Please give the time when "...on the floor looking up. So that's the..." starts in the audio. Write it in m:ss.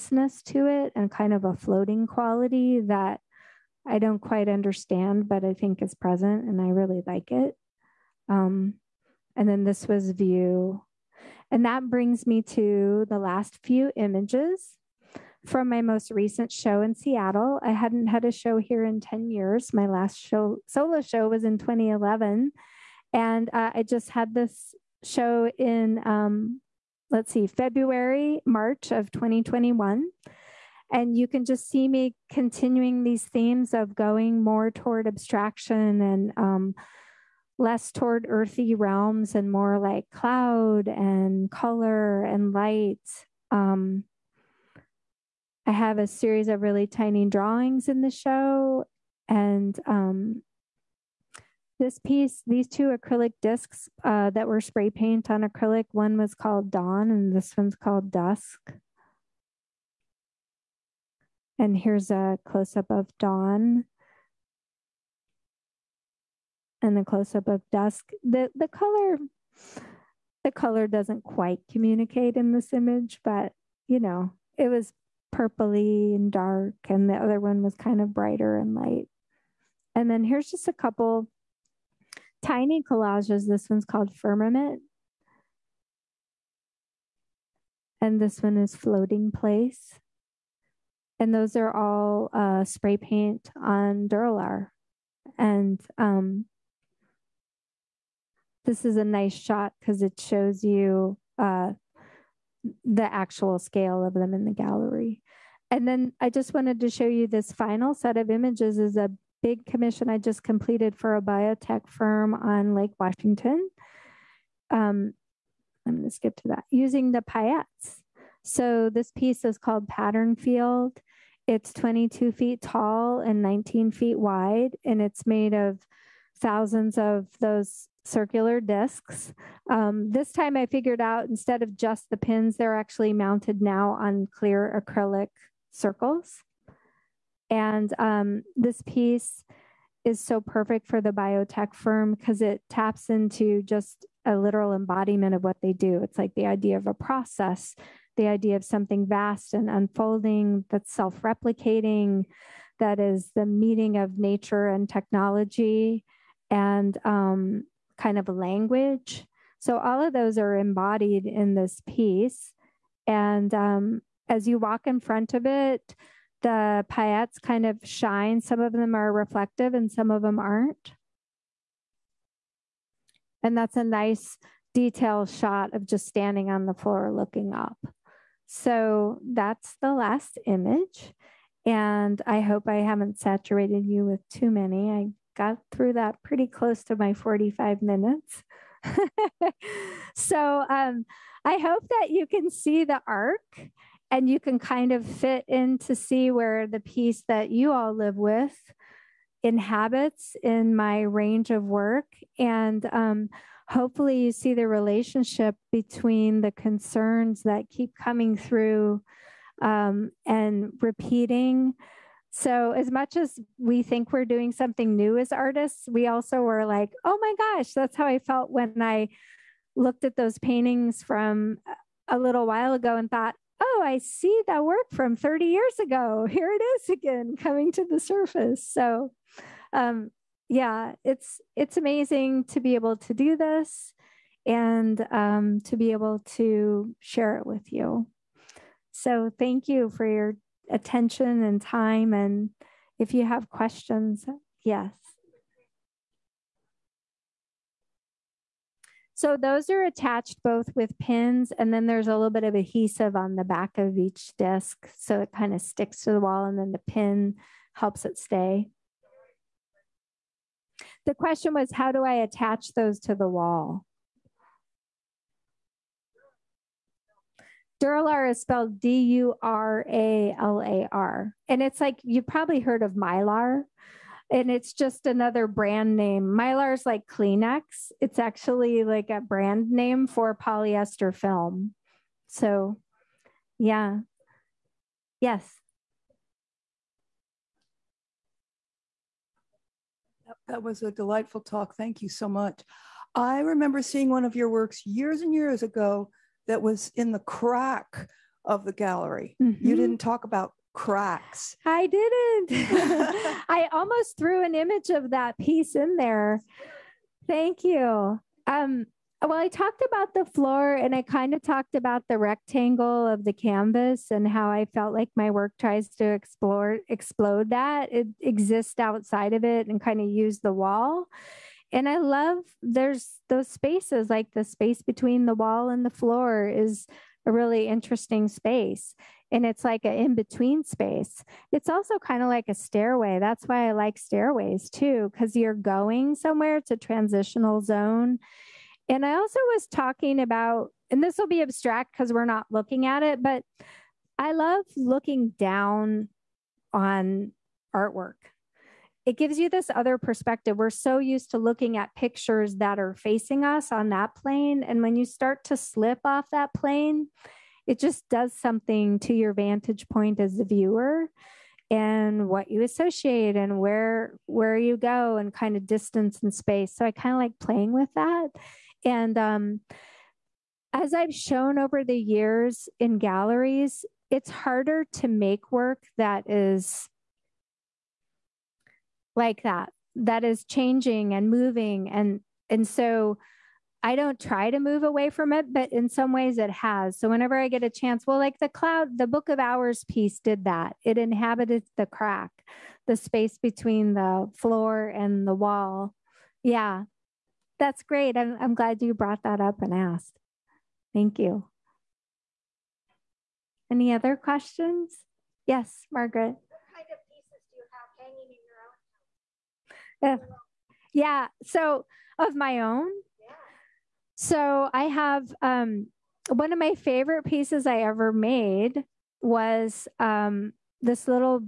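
2:56.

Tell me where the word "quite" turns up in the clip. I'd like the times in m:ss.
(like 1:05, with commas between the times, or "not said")
0:04, 1:11.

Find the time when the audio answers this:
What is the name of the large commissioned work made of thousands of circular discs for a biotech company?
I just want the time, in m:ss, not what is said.
1:59.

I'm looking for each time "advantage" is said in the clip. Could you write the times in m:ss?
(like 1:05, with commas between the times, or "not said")
not said.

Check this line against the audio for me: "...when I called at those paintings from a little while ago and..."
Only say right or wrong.
wrong.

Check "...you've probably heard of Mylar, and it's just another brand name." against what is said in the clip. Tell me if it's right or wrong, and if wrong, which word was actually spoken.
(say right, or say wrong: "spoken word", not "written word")
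right.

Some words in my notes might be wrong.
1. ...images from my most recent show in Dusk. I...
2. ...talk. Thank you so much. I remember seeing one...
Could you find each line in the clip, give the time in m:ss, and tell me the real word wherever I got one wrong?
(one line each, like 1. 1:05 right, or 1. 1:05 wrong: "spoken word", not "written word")
1. 0:13 wrong: "Seattle", not "Dusk"
2. 4:51 right.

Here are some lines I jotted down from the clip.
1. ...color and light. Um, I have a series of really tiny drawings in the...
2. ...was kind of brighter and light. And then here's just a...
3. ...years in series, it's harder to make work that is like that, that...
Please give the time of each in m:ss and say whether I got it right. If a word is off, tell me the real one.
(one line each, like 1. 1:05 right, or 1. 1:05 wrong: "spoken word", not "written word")
1. 0:41 right
2. 1:17 right
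3. 6:11 wrong: "galleries", not "series".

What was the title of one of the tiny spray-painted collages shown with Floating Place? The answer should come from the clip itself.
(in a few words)
Firmament.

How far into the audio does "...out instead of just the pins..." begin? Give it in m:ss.
2:11.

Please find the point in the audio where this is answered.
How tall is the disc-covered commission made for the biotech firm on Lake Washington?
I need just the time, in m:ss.
2:01.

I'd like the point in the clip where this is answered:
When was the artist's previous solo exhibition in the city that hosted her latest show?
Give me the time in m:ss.
0:21.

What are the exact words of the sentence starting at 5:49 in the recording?
It gives you this other perspective.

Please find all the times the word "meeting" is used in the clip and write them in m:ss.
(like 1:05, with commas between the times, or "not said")
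2:33.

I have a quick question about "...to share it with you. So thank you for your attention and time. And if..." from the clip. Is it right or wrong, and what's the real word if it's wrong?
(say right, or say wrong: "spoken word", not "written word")
right.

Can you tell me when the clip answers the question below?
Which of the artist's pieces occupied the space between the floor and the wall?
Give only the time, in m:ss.
6:29.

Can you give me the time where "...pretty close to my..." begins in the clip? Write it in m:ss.
3:06.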